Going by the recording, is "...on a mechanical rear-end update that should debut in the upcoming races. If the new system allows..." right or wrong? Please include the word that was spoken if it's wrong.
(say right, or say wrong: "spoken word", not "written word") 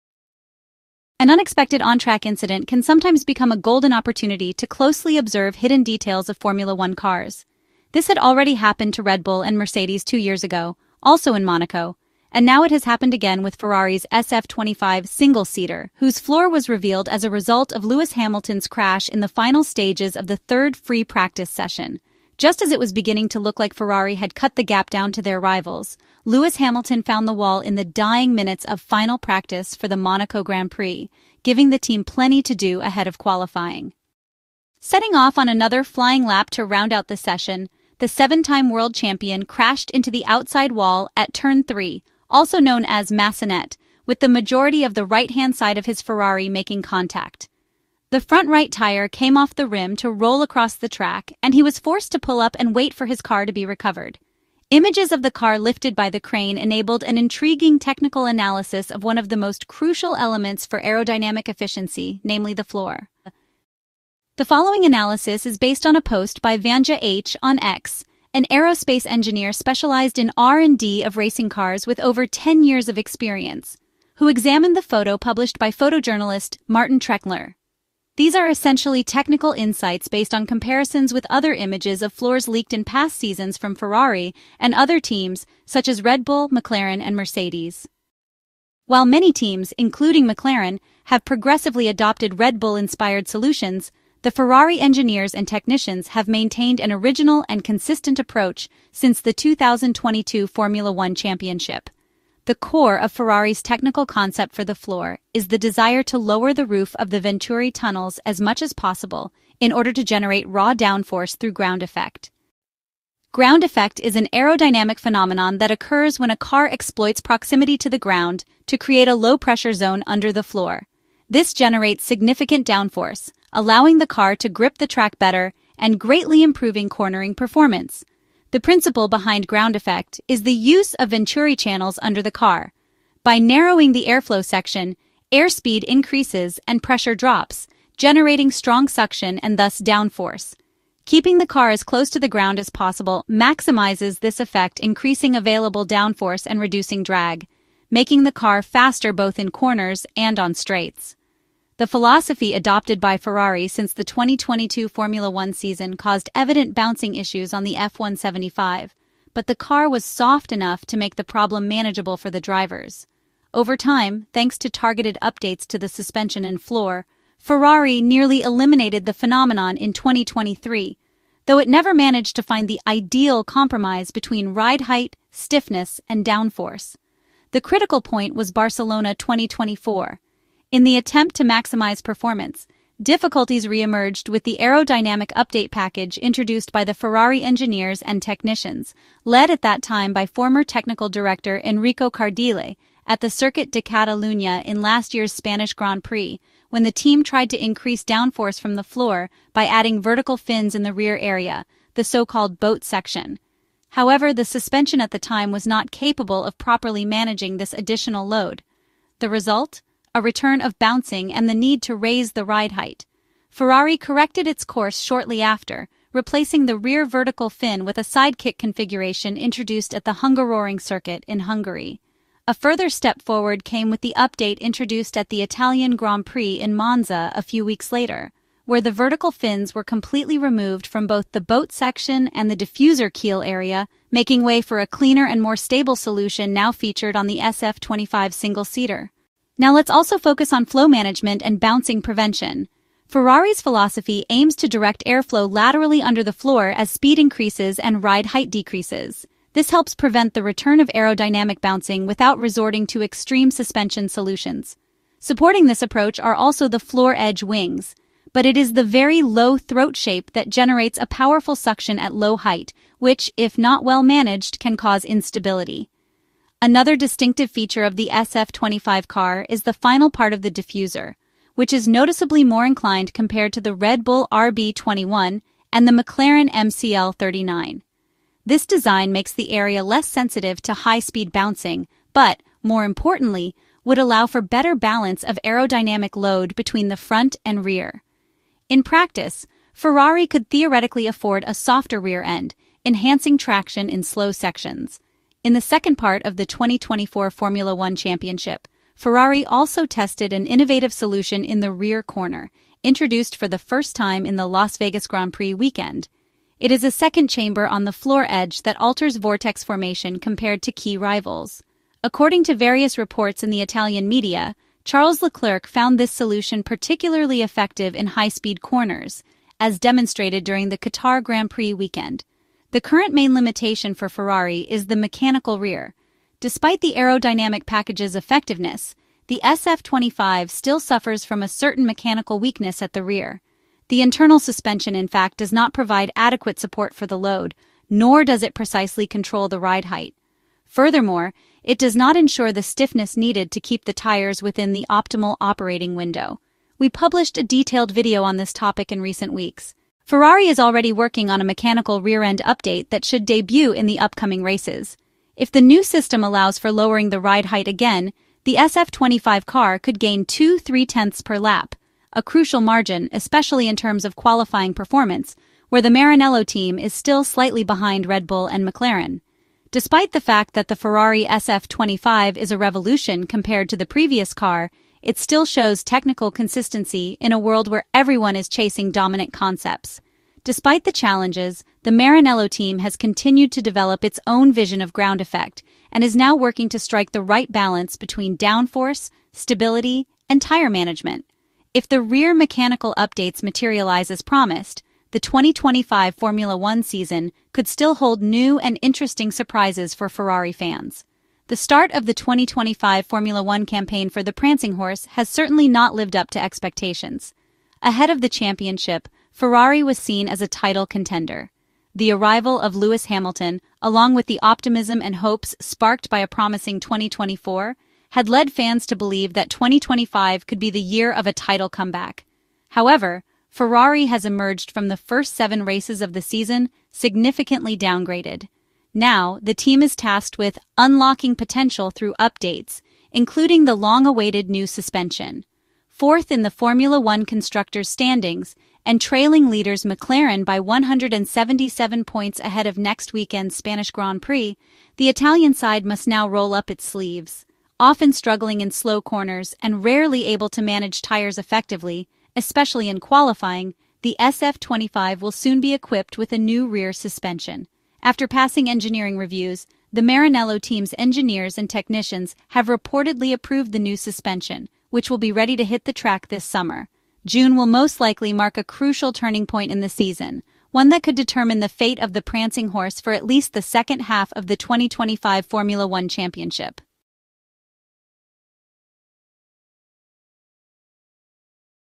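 right.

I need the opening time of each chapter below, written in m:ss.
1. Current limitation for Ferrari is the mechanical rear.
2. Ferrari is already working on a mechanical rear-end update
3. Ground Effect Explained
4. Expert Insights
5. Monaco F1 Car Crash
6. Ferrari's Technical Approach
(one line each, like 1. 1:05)
1. 3:59
2. 5:49
3. 1:52
4. 1:03
5. 0:34
6. 1:28.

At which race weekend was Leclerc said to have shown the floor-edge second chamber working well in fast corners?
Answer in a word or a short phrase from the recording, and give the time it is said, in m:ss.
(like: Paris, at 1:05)
Qatar Grand Prix, at 5:20.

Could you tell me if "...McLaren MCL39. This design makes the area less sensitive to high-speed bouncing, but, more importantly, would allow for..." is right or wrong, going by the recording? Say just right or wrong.
right.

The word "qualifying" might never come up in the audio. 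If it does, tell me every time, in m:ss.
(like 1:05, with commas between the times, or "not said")
0:33, 6:04, 7:32.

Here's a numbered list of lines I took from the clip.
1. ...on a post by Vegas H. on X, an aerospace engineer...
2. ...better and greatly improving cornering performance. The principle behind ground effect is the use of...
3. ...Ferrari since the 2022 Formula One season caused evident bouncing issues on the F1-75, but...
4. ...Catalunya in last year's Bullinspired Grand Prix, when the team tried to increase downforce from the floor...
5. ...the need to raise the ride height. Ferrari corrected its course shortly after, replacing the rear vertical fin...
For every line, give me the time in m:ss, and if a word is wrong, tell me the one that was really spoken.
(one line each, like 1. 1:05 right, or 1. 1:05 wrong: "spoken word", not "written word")
1. 1:05 wrong: "Vanja", not "Vegas"
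2. 2:05 right
3. 2:33 right
4. 3:13 wrong: "Spanish", not "Bullinspired"
5. 3:31 right.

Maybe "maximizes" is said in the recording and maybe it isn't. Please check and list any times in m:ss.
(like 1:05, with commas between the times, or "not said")
2:23, 3:01.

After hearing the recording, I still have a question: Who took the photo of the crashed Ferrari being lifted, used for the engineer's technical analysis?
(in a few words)
Martin Treckler.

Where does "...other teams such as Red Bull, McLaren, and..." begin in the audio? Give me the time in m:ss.
1:24.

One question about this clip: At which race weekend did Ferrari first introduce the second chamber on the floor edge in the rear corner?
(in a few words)
Las Vegas Grand Prix.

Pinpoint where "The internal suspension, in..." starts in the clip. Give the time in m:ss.
5:33.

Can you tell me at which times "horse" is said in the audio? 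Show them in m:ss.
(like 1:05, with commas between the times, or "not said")
6:44, 7:52.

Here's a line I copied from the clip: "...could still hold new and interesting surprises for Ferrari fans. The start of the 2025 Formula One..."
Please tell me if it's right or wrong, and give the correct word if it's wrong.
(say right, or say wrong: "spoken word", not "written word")
right.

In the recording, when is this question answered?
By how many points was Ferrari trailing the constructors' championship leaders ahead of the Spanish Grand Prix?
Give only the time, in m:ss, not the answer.
7:20.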